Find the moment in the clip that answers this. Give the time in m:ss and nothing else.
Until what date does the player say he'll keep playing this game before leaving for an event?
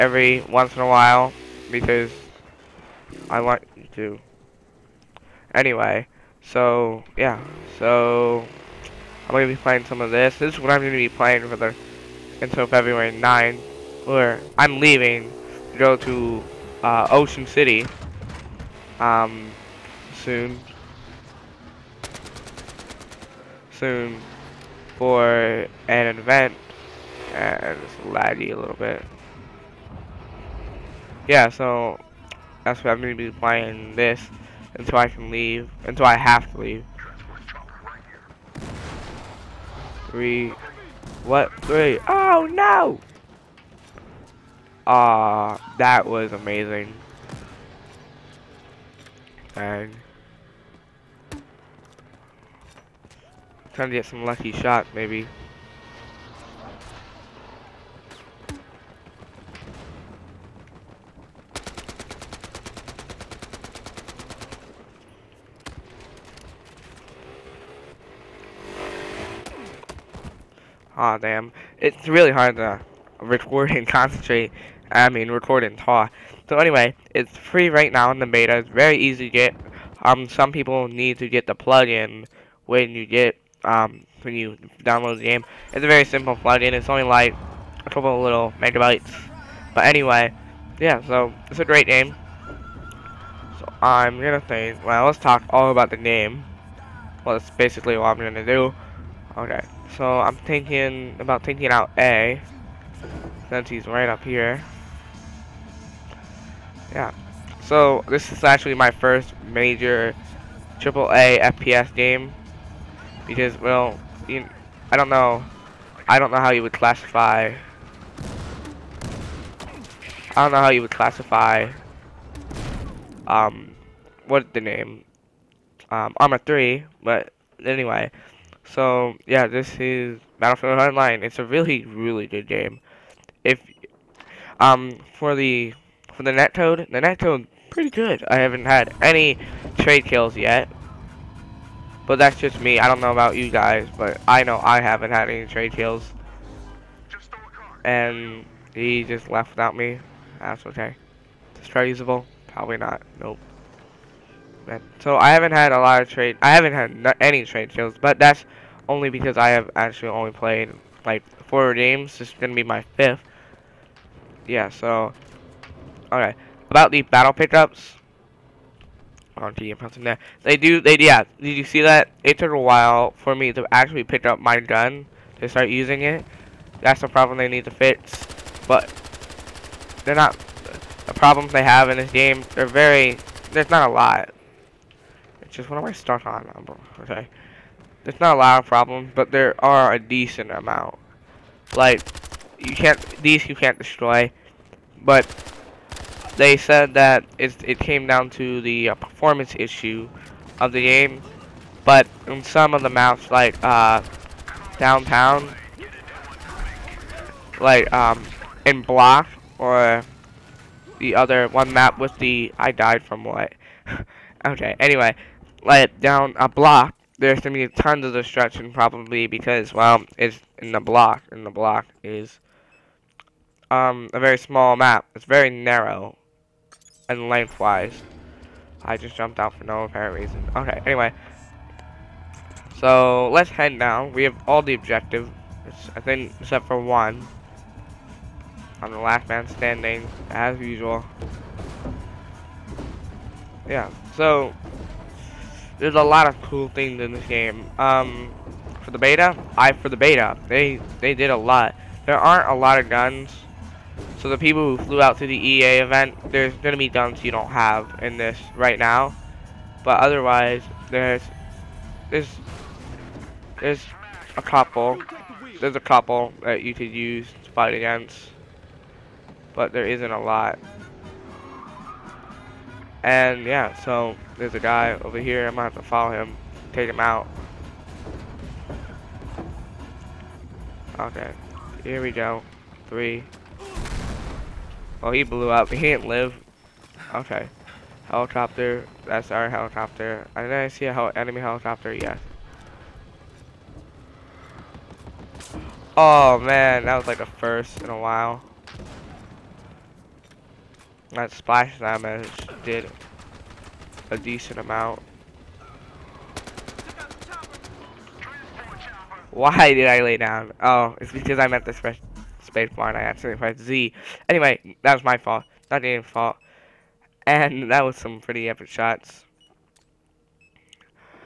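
0:12.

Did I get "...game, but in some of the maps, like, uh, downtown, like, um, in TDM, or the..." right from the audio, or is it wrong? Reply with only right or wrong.
wrong.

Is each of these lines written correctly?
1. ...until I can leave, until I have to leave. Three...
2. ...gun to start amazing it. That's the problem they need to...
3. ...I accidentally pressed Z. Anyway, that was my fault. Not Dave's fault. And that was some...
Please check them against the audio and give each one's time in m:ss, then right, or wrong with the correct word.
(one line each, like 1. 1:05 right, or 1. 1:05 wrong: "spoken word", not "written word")
1. 0:34 right
2. 2:54 wrong: "using", not "amazing"
3. 5:12 right.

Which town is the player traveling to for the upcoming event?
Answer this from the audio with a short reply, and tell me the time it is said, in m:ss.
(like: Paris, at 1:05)
Ocean City, at 0:17.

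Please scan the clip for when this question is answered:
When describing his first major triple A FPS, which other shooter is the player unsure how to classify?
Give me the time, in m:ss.
2:06.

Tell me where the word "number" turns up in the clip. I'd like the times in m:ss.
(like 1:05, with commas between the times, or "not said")
3:06.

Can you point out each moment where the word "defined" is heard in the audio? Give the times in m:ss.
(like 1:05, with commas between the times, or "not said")
not said.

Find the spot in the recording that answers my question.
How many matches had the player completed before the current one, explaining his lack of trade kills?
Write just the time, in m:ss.
2:41.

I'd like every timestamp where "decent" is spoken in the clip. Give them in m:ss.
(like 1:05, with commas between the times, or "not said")
3:09, 5:04.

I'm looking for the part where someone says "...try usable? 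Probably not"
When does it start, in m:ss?
2:31.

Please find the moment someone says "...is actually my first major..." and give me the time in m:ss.
1:48.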